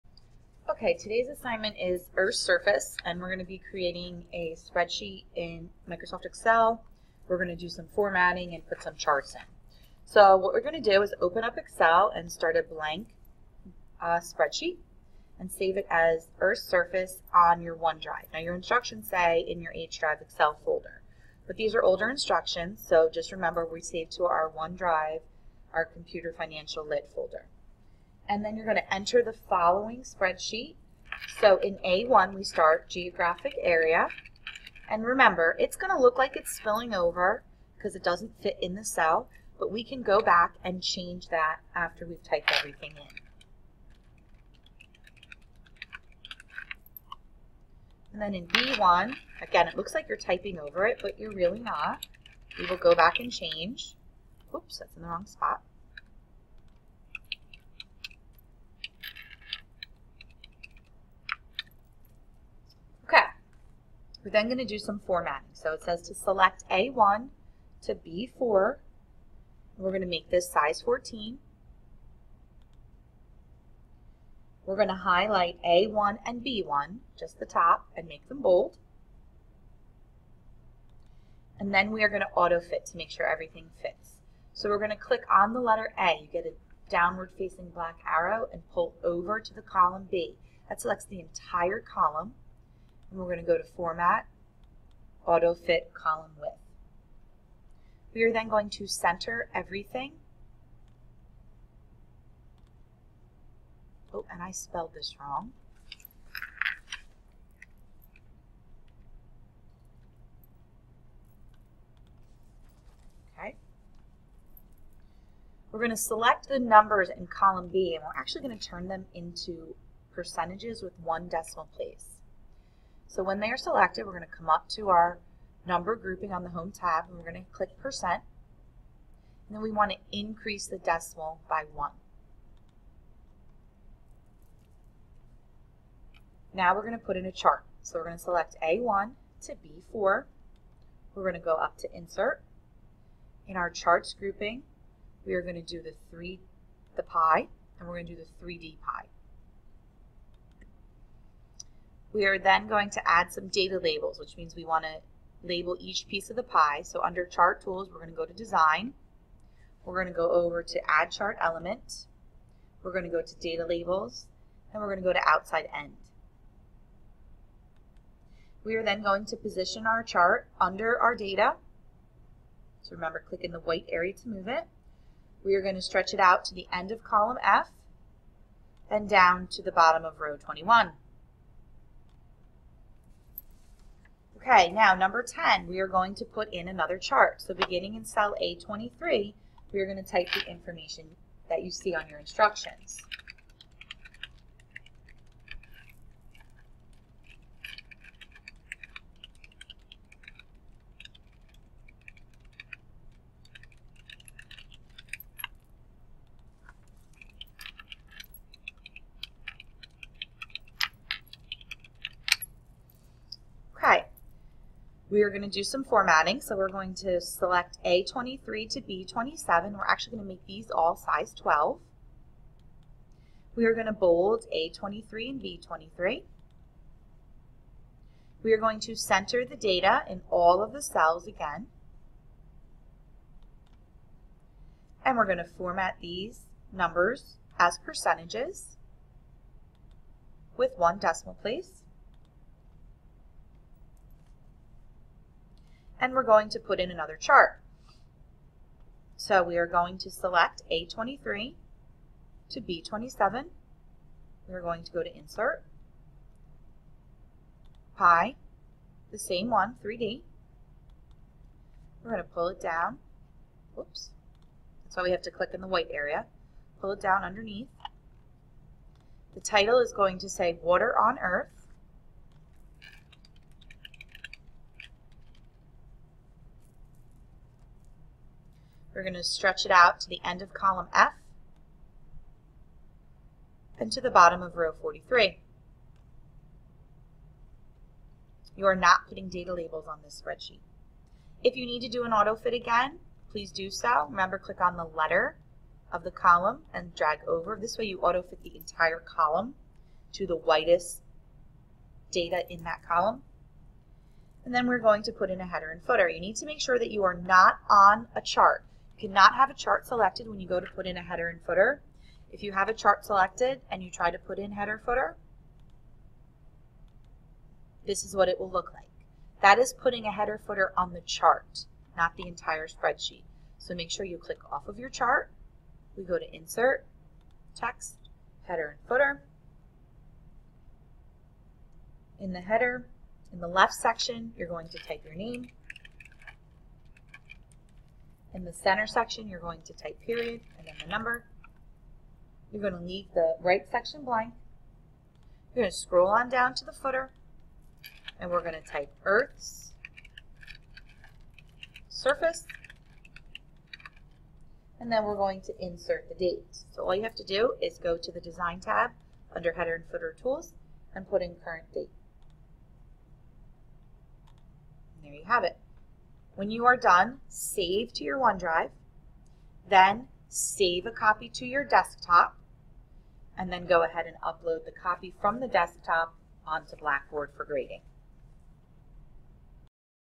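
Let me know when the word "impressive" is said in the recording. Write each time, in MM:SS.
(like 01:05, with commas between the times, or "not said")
not said.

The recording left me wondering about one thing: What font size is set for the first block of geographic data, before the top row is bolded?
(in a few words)
14.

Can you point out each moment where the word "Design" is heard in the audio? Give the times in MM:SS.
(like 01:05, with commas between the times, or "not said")
02:38, 05:58.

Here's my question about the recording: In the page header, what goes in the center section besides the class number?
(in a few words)
period.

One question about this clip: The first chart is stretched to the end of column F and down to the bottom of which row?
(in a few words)
21.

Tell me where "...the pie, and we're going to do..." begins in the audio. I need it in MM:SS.
02:26.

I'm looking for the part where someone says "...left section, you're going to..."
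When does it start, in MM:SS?
05:33.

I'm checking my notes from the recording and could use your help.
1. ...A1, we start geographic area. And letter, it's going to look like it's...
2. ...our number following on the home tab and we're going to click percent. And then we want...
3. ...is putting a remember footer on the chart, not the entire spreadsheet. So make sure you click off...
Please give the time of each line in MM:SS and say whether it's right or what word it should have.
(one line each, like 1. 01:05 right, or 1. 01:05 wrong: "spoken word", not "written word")
1. 00:31 wrong: "remember", not "letter"
2. 02:04 wrong: "grouping", not "following"
3. 05:19 wrong: "header", not "remember".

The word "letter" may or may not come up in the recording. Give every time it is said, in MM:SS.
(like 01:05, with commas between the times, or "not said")
01:25, 04:54.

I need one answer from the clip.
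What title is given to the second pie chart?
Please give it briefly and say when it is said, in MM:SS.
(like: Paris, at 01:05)
Water on Earth, at 04:30.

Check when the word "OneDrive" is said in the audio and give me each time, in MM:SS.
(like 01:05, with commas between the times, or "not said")
00:17, 00:24, 06:08.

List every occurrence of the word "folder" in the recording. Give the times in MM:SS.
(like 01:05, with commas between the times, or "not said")
00:20, 00:27.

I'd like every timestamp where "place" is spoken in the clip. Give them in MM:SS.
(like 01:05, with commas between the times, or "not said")
02:01, 04:01.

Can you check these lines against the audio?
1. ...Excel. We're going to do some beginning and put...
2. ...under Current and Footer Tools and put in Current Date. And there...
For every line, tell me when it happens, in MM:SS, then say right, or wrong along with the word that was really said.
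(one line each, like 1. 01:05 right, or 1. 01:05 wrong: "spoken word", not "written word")
1. 00:06 wrong: "formatting", not "beginning"
2. 05:59 wrong: "Header", not "Current".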